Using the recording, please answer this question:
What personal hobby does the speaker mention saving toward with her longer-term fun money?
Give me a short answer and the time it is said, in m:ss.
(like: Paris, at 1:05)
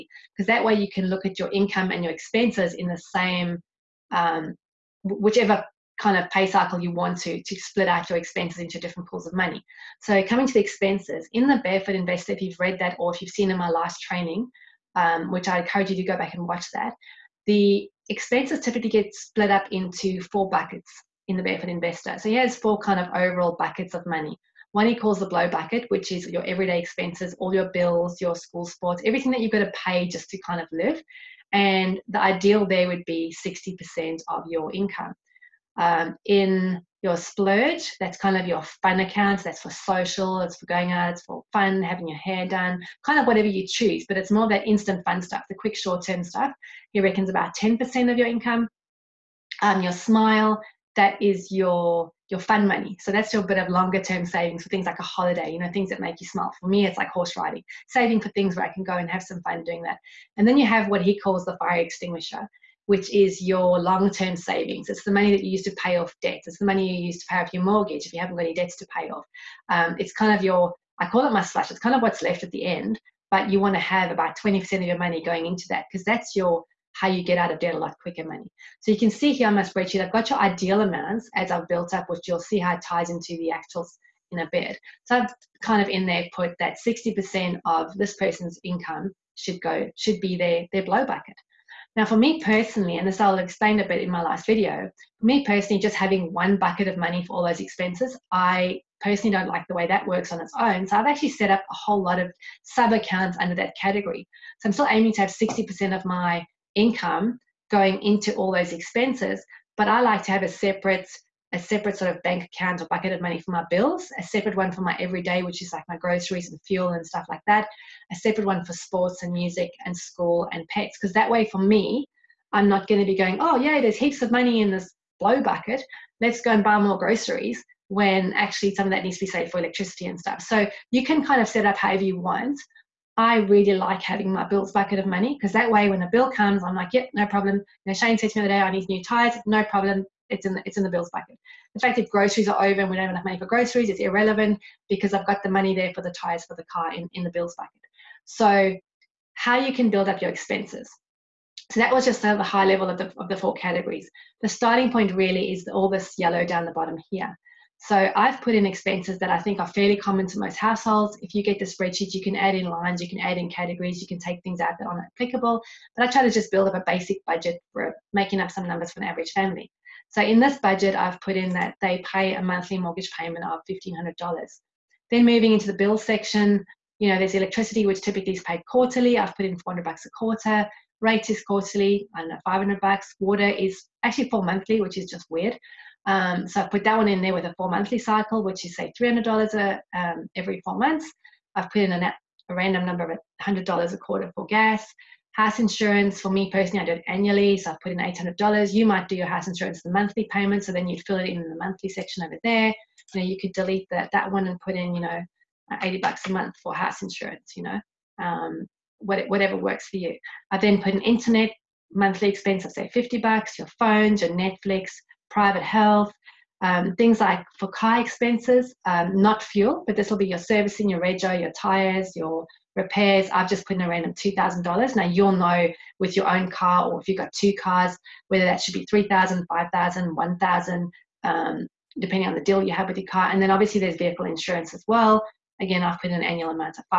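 Horse riding, at 0:57.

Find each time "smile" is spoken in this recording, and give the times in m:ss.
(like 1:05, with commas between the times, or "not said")
0:49, 0:56.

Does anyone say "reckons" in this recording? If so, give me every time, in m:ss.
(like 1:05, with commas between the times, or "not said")
0:47.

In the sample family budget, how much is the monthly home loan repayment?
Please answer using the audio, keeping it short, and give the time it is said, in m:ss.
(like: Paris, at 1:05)
$1,500, at 2:53.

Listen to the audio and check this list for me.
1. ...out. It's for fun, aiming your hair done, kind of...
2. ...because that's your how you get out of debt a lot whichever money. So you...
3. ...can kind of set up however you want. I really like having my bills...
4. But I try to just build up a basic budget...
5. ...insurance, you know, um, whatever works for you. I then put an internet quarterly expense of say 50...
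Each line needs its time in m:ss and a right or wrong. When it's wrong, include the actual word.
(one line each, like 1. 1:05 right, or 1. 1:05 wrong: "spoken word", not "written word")
1. 0:40 wrong: "having", not "aiming"
2. 1:15 wrong: "quicker", not "whichever"
3. 2:11 right
4. 2:45 right
5. 3:27 wrong: "monthly", not "quarterly".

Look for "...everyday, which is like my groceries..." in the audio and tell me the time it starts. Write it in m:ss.
1:54.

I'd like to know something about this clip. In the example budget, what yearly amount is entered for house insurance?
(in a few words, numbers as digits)
$800.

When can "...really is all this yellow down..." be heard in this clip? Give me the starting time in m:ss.
2:35.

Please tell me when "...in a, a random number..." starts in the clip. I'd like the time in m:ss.
3:11.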